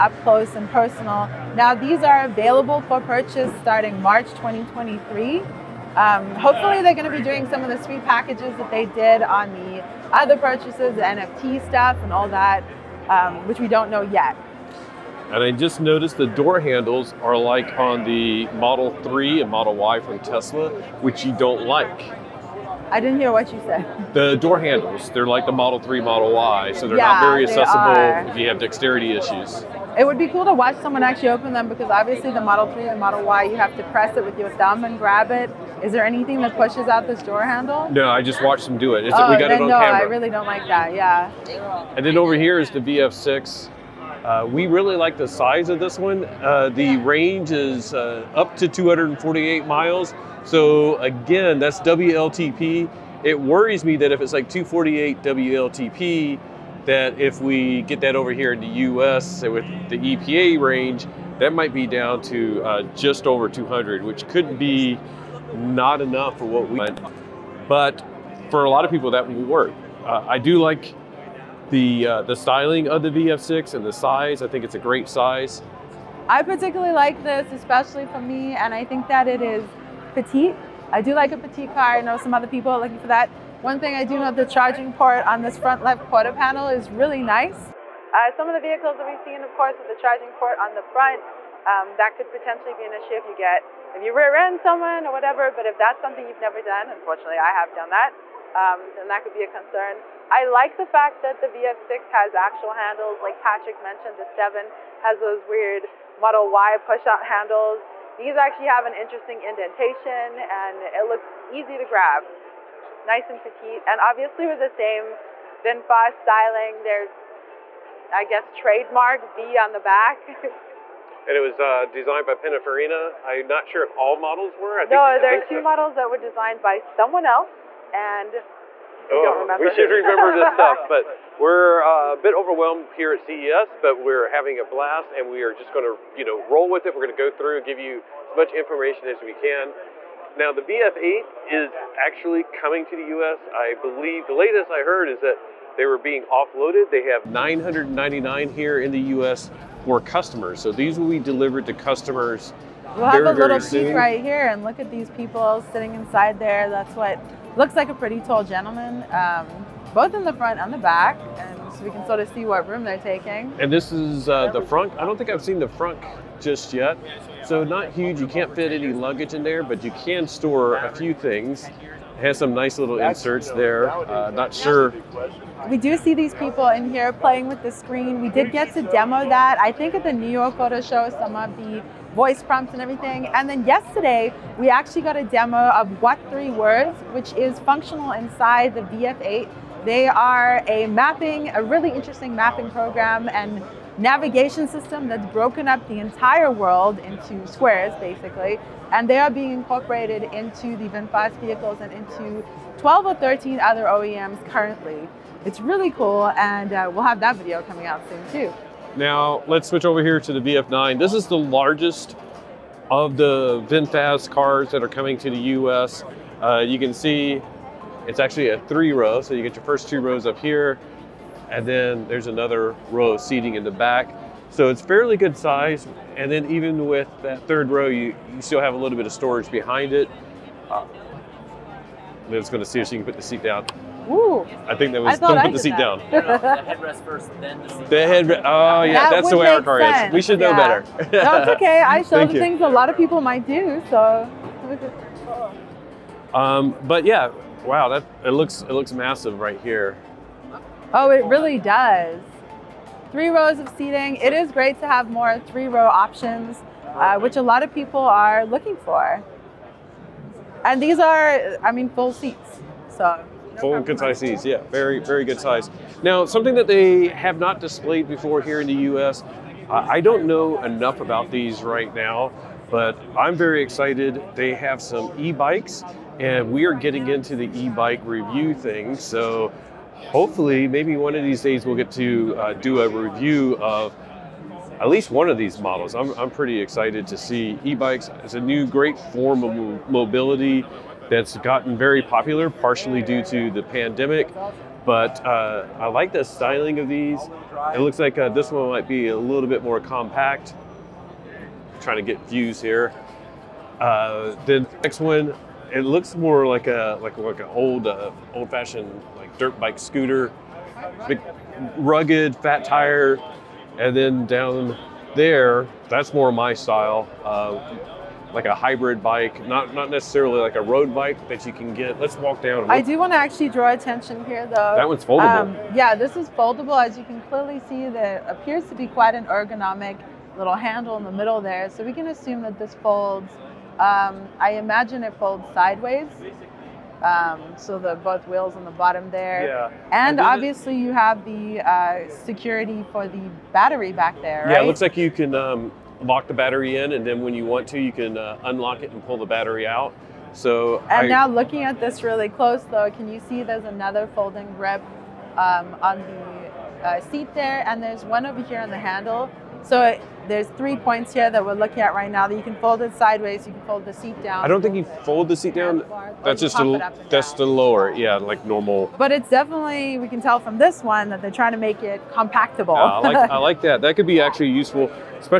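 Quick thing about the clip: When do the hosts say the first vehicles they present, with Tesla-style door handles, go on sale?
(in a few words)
March 2023.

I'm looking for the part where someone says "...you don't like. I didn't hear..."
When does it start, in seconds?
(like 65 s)
21 s.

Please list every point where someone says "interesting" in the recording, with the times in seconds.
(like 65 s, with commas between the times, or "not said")
108 s, 191 s.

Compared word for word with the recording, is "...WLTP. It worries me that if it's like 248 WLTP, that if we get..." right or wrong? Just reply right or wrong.
right.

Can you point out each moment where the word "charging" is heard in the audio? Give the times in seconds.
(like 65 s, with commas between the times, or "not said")
84 s, 89 s.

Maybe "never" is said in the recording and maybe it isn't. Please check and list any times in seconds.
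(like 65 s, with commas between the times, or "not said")
96 s.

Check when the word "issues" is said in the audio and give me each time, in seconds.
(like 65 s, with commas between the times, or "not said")
29 s, 92 s.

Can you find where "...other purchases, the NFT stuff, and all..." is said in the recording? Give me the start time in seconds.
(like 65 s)
10 s.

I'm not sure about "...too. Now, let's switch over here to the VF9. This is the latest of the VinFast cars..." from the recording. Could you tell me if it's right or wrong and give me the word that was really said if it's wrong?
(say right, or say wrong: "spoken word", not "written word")
wrong: "largest", not "latest".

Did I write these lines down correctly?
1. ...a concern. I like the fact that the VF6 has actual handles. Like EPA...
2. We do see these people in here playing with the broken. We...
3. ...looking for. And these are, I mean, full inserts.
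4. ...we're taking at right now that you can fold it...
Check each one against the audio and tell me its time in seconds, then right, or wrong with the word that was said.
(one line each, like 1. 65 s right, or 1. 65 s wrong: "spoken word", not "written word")
1. 99 s wrong: "Patrick", not "EPA"
2. 175 s wrong: "screen", not "broken"
3. 258 s wrong: "seats", not "inserts"
4. 361 s wrong: "looking", not "taking".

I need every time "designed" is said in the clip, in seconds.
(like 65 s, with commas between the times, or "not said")
121 s, 126 s.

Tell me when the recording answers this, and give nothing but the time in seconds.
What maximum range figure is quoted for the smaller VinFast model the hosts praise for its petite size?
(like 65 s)
48 s.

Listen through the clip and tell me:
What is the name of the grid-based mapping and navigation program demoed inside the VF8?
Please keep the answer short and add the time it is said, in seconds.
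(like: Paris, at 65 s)
What Three Words, at 186 s.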